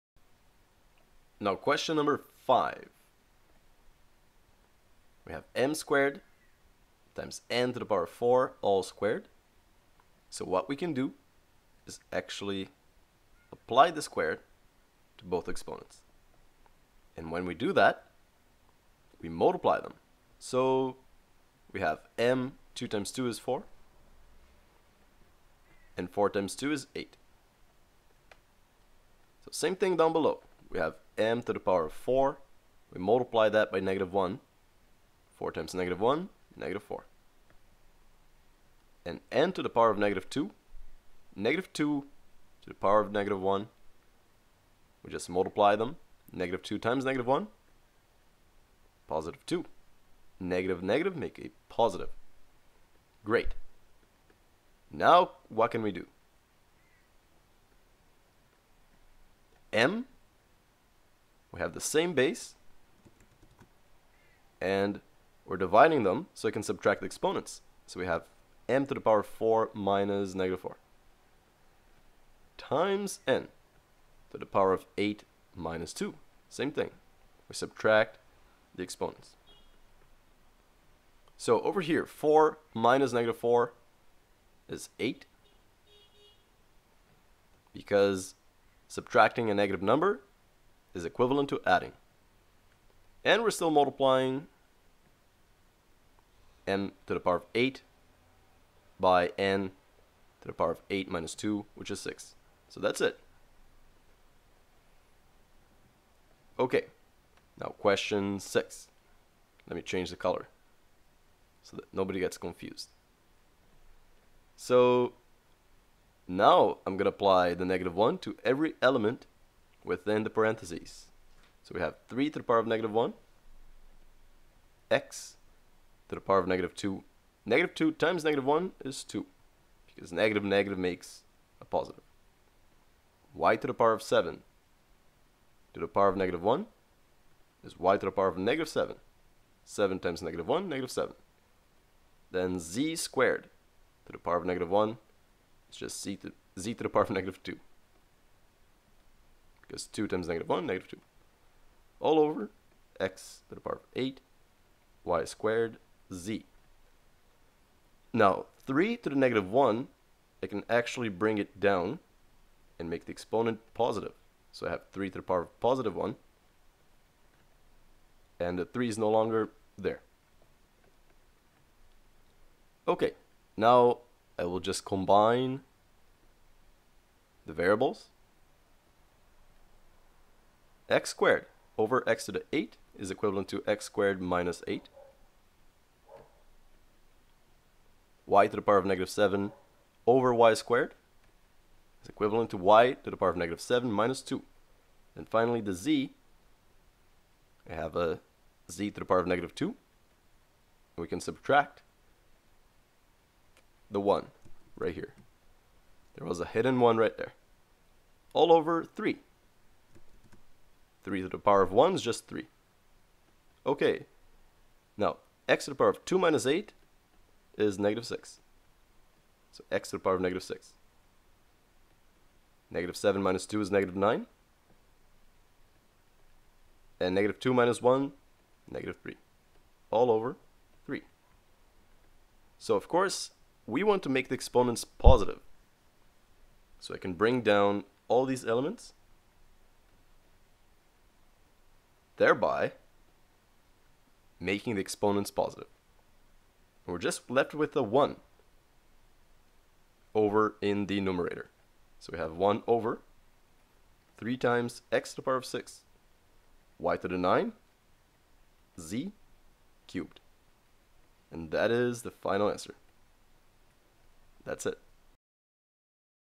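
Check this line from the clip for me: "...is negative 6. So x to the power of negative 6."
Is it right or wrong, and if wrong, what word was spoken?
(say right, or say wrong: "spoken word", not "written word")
right.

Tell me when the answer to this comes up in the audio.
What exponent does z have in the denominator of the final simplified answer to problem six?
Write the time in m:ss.
4:18.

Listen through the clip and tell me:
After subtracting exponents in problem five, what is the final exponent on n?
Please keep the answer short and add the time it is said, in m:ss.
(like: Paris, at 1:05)
6, at 1:41.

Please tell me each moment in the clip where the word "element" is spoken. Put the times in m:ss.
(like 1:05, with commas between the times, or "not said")
1:58, 3:58.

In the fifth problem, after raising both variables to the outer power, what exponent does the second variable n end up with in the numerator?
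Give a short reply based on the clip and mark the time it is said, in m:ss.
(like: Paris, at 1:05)
8, at 0:26.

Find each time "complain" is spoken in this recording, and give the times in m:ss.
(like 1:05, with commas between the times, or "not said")
not said.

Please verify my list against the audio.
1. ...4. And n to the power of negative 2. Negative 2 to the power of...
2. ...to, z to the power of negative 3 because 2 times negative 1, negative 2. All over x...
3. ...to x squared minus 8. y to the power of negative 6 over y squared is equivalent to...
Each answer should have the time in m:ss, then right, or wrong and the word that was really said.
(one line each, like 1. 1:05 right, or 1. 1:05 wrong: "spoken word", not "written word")
1. 0:36 right
2. 2:26 wrong: "2", not "3"
3. 3:03 wrong: "7", not "6".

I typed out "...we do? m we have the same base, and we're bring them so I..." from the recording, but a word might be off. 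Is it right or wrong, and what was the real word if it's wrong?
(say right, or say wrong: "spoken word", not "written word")
wrong: "dividing", not "bring".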